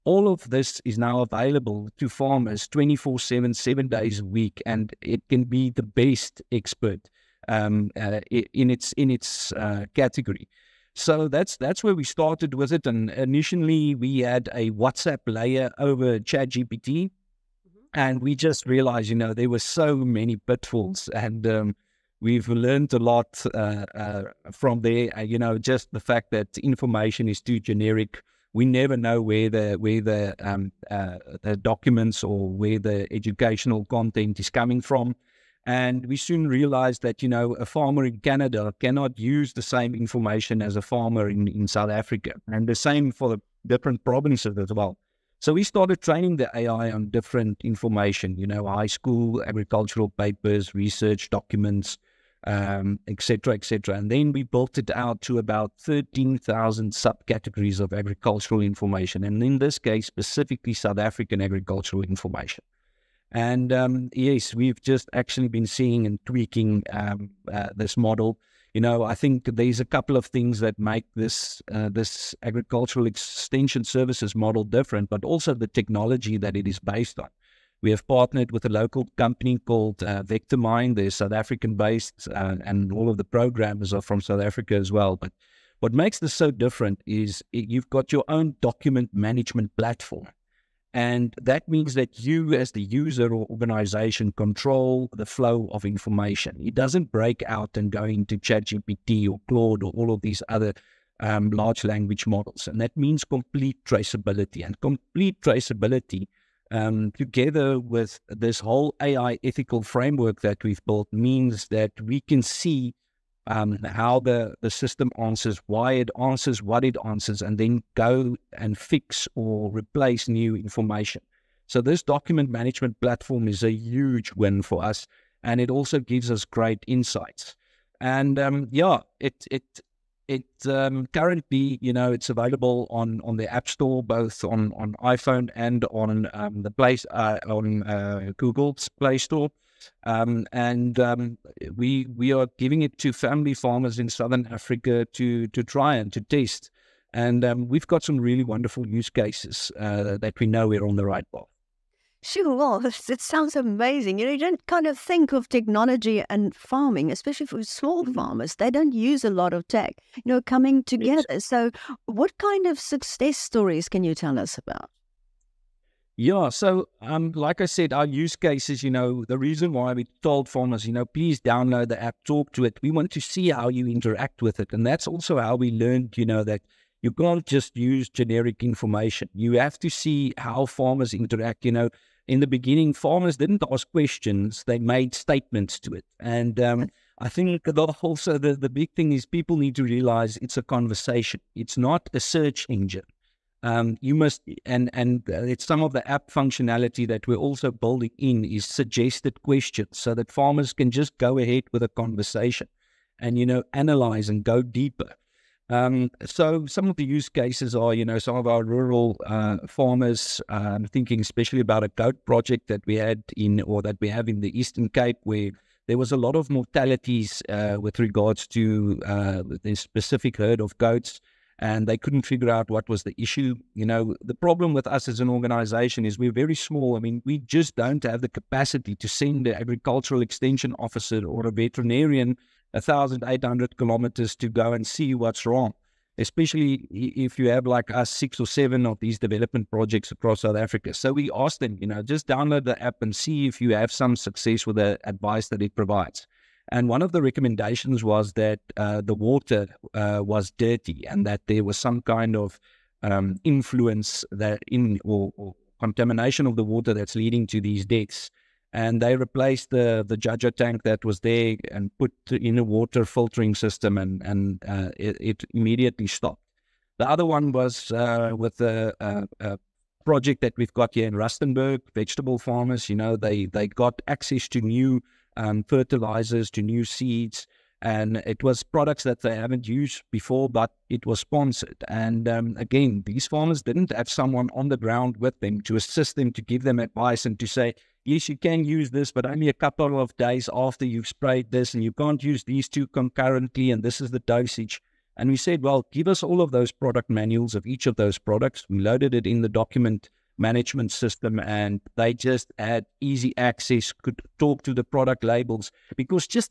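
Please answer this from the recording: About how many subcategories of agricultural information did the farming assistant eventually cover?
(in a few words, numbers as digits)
13,000.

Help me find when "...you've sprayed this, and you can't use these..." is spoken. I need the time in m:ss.
4:50.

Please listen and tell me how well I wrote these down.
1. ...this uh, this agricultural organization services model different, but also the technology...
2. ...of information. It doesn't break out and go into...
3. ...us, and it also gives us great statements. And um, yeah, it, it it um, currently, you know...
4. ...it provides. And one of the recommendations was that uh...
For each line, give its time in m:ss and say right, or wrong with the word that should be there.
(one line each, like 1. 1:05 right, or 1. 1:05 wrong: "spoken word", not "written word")
1. 1:11 wrong: "extension", not "organization"
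2. 1:35 right
3. 2:04 wrong: "insights", not "statements"
4. 4:05 right.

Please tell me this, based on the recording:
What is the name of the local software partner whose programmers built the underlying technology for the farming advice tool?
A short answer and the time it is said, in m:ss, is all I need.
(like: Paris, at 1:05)
Vectormind, at 1:20.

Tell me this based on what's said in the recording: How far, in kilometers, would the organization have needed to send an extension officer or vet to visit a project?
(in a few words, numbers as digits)
1,800.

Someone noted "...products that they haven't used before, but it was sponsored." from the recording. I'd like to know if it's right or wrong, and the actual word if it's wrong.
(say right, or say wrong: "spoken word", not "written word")
right.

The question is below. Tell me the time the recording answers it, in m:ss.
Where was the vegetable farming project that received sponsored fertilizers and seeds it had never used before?
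4:31.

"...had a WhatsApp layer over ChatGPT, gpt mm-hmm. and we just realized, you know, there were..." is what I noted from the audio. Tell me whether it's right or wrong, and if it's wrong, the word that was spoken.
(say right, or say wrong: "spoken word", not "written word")
right.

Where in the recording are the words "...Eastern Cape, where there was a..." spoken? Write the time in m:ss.
3:34.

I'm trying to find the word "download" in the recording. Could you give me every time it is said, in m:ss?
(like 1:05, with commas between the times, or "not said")
2:51, 4:02.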